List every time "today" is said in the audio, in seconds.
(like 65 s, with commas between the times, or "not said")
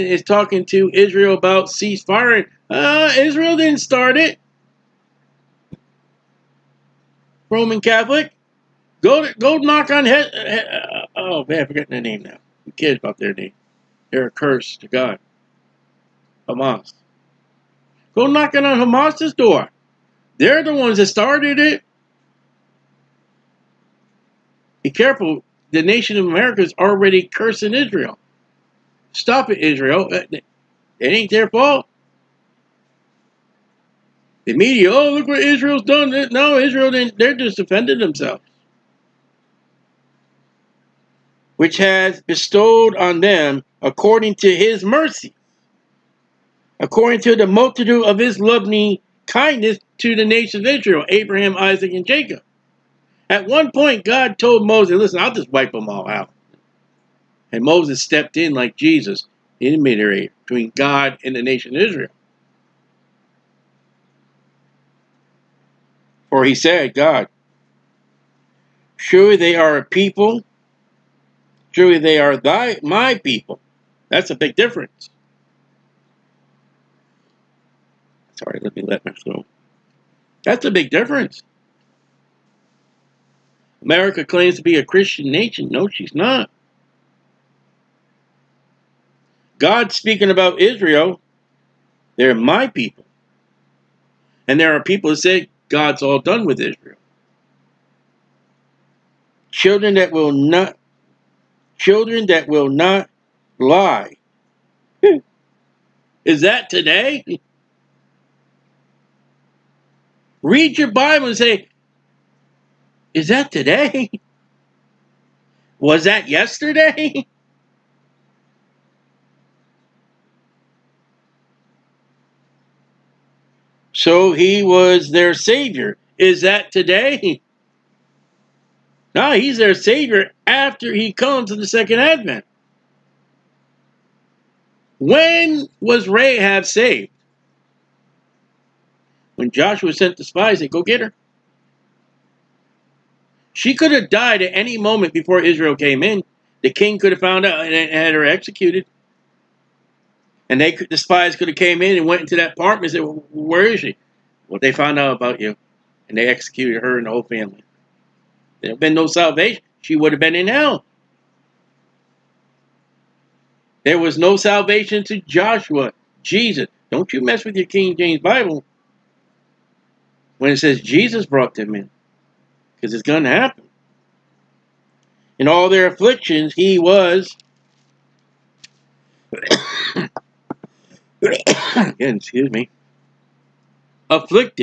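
106 s, 113 s, 126 s.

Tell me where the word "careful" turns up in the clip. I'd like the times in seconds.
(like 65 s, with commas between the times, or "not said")
24 s.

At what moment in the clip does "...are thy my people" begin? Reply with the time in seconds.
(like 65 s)
72 s.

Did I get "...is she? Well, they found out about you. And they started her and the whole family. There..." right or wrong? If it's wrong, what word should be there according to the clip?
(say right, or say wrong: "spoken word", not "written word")
wrong: "executed", not "started".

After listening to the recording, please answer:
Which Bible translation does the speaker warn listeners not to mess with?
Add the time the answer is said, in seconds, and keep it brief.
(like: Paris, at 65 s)
King James Bible, at 167 s.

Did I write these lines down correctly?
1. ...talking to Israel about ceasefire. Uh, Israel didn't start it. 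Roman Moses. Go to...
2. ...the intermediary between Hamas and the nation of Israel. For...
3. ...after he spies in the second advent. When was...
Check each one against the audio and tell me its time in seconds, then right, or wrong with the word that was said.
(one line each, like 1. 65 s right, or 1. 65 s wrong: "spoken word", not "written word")
1. 0 s wrong: "Catholic", not "Moses"
2. 59 s wrong: "God", not "Hamas"
3. 130 s wrong: "comes", not "spies".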